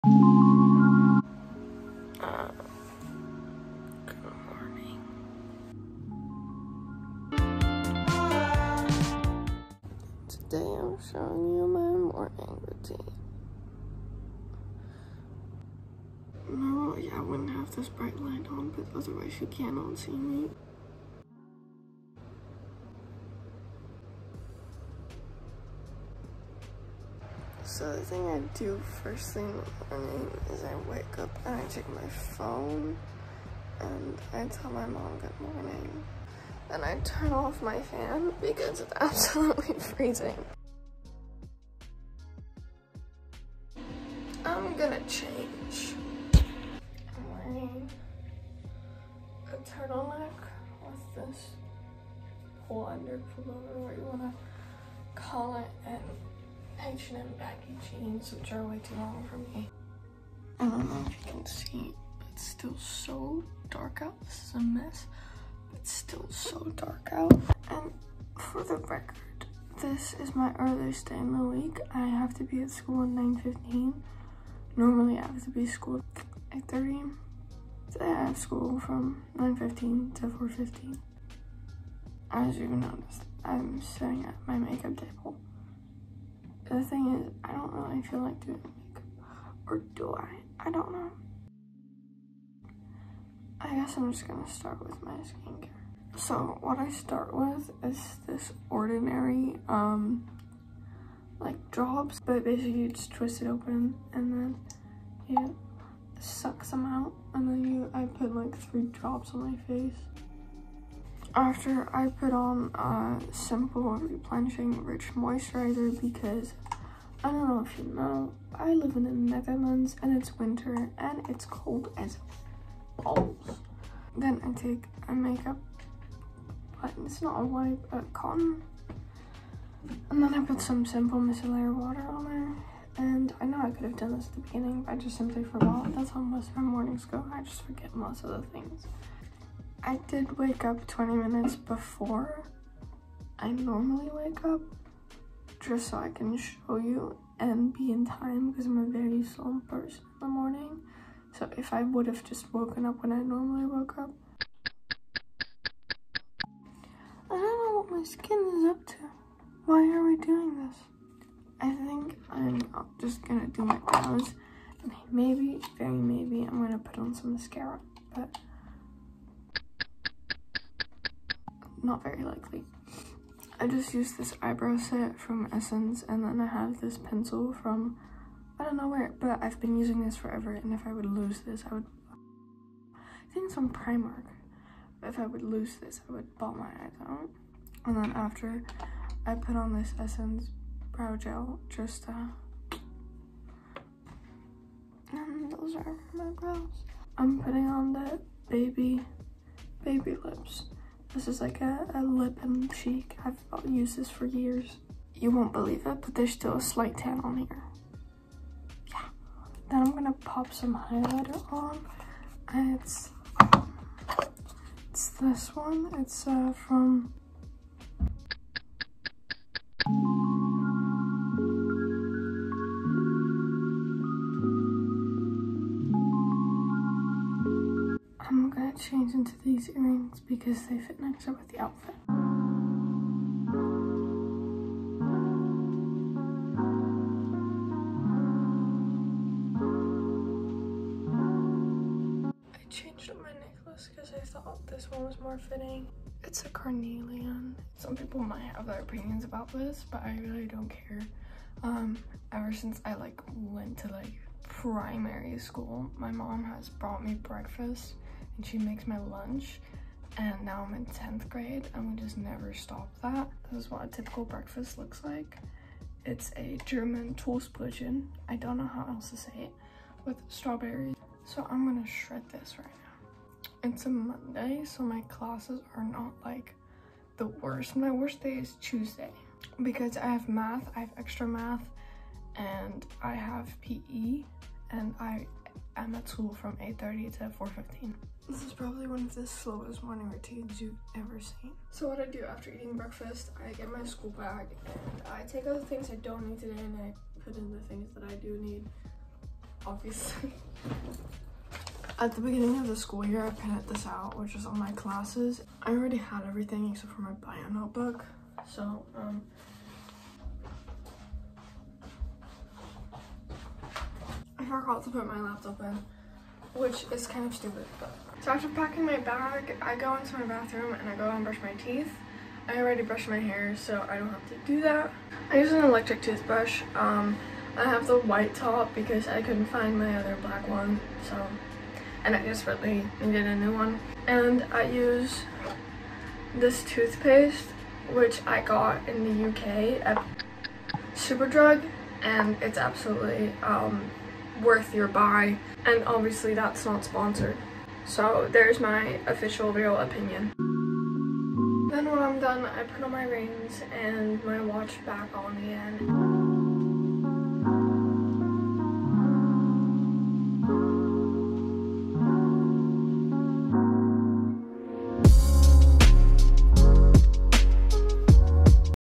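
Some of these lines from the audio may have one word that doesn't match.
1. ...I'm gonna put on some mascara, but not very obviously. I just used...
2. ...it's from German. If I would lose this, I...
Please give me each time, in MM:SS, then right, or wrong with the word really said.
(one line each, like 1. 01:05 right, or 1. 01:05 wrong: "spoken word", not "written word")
1. 02:46 wrong: "likely", not "obviously"
2. 03:03 wrong: "Primark", not "German".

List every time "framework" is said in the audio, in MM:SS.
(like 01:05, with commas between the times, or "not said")
not said.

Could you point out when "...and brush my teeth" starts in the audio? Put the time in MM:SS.
05:21.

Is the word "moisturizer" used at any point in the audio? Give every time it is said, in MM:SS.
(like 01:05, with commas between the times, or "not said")
01:55.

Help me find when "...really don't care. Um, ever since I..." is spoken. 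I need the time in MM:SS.
04:10.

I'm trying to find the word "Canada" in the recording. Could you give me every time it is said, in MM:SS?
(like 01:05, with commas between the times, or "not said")
not said.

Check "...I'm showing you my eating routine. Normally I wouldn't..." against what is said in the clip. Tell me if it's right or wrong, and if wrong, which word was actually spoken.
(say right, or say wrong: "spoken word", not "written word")
wrong: "morning", not "eating".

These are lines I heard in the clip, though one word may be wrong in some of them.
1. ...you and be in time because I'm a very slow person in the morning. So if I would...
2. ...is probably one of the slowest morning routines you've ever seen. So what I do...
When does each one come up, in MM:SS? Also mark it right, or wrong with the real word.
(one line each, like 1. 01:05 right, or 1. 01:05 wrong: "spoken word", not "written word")
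1. 02:26 right
2. 04:48 right.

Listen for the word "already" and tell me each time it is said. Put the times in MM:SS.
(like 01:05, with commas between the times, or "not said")
05:05, 05:22.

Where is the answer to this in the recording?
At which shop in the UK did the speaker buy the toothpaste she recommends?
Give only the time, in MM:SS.
05:40.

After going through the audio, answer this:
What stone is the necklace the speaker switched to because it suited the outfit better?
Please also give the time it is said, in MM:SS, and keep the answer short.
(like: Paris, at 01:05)
carnelian, at 04:06.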